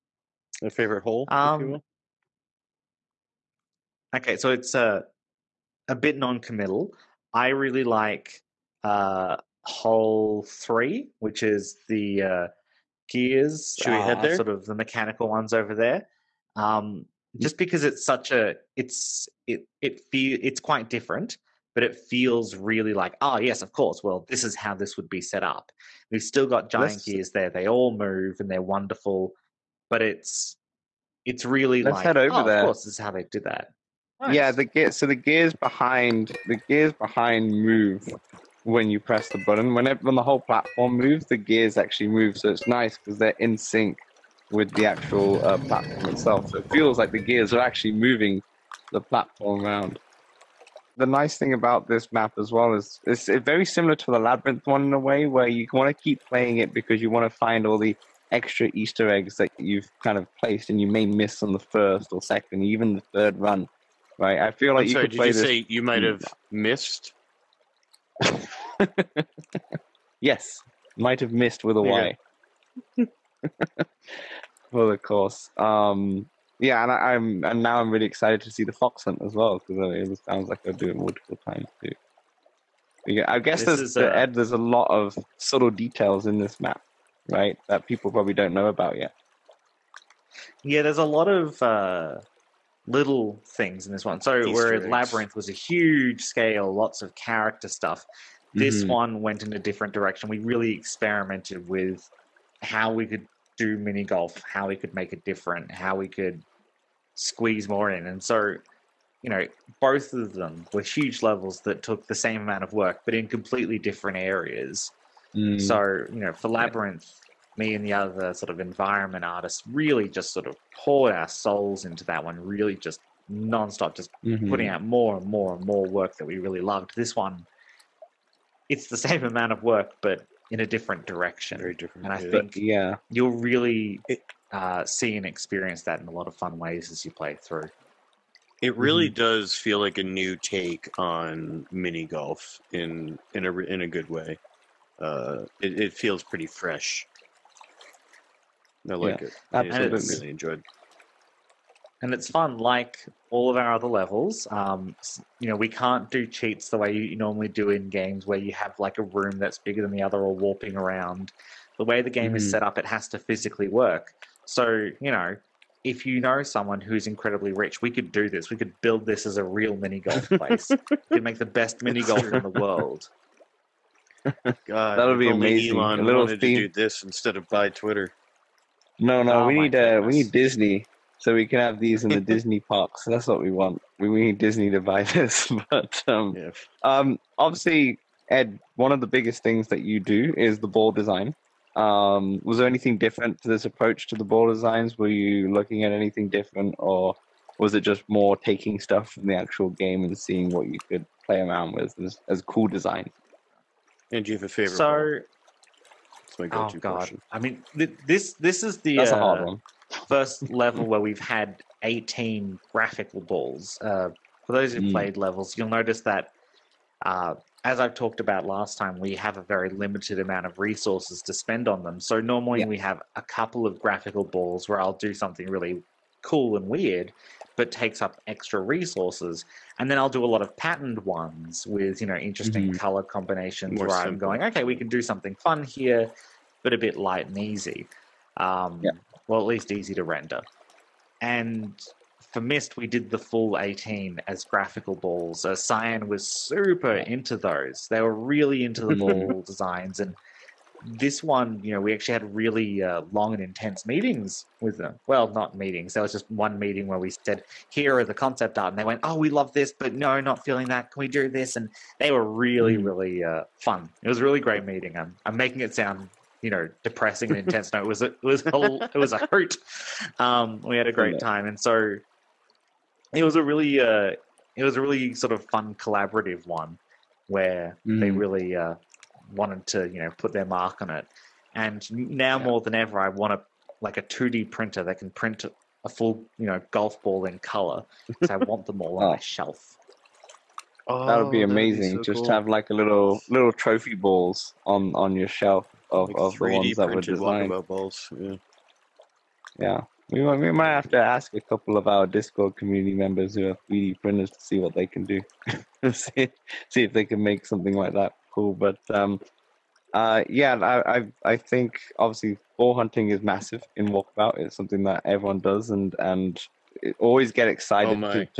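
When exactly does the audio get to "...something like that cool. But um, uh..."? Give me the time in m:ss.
5:07.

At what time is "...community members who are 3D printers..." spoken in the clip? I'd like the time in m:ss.
5:02.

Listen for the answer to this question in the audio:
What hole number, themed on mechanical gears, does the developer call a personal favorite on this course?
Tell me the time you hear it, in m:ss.
0:10.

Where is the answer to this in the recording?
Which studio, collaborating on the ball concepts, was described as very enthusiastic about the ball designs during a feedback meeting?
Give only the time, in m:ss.
4:05.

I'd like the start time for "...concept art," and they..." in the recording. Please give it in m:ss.
4:18.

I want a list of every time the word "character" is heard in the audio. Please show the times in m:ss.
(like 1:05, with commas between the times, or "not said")
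1:37.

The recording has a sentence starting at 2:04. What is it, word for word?
putting out more and more and more work that we really loved.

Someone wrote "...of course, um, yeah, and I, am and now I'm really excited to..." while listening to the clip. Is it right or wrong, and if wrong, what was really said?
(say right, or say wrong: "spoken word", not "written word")
right.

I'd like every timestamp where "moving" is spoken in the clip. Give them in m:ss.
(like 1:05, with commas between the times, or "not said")
0:47.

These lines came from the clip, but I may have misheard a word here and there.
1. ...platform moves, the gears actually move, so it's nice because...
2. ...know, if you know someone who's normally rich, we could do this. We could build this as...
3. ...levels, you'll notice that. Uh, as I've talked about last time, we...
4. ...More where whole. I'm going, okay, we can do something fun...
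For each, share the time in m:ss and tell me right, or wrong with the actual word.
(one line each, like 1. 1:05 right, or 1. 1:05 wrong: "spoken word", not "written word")
1. 0:40 right
2. 2:45 wrong: "incredibly", not "normally"
3. 3:35 right
4. 3:53 wrong: "simple", not "whole".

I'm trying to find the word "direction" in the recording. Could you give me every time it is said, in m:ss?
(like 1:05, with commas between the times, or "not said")
1:39, 2:11.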